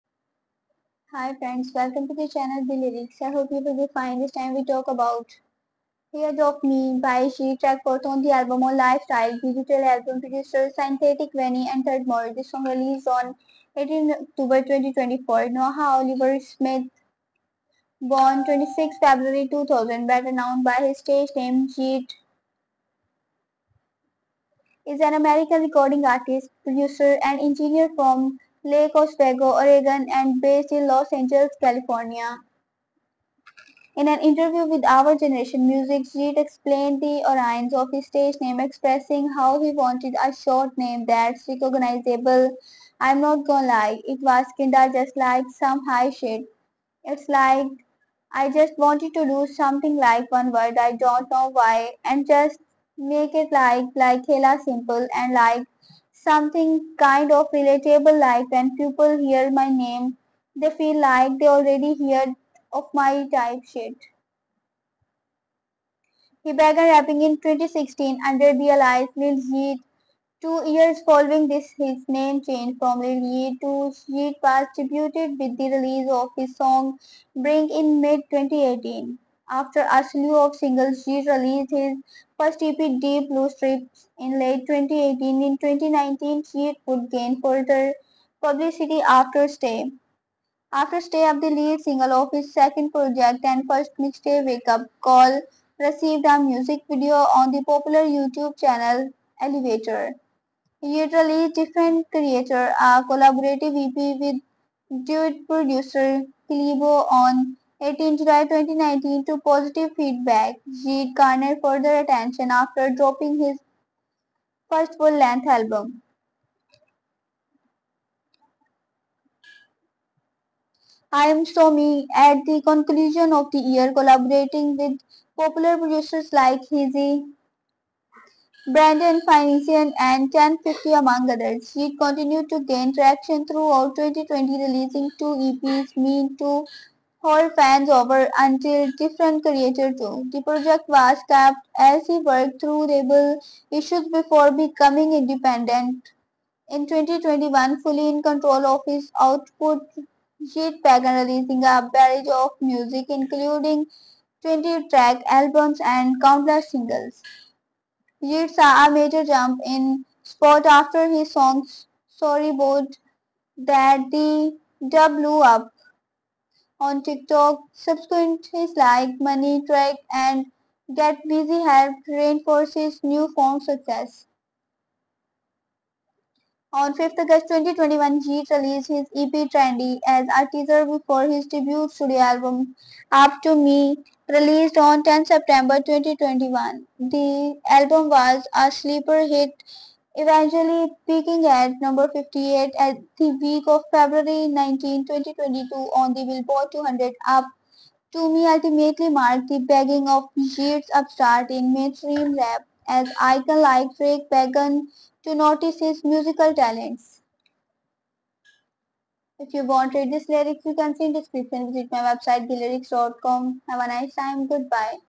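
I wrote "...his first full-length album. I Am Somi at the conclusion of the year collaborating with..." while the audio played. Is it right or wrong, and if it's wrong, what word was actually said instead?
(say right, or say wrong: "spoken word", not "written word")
right.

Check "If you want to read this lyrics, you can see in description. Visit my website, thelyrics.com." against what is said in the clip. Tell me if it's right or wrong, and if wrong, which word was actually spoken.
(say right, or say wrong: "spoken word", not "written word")
right.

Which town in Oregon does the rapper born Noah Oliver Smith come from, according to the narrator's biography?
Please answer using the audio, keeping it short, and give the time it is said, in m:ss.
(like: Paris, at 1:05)
Lake Oswego, at 0:28.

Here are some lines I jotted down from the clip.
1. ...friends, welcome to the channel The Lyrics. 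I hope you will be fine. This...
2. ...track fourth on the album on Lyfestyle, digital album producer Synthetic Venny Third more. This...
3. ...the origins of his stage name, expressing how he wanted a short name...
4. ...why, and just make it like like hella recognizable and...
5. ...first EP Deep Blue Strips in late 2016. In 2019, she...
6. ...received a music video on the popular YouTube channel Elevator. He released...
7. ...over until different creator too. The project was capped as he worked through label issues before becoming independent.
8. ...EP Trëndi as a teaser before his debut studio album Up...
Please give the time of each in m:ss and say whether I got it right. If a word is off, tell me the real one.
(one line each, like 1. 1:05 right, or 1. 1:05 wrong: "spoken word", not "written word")
1. 0:01 right
2. 0:07 right
3. 0:37 right
4. 0:51 wrong: "simple", not "recognizable"
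5. 1:22 wrong: "2018", not "2016"
6. 1:35 right
7. 2:17 right
8. 2:59 right.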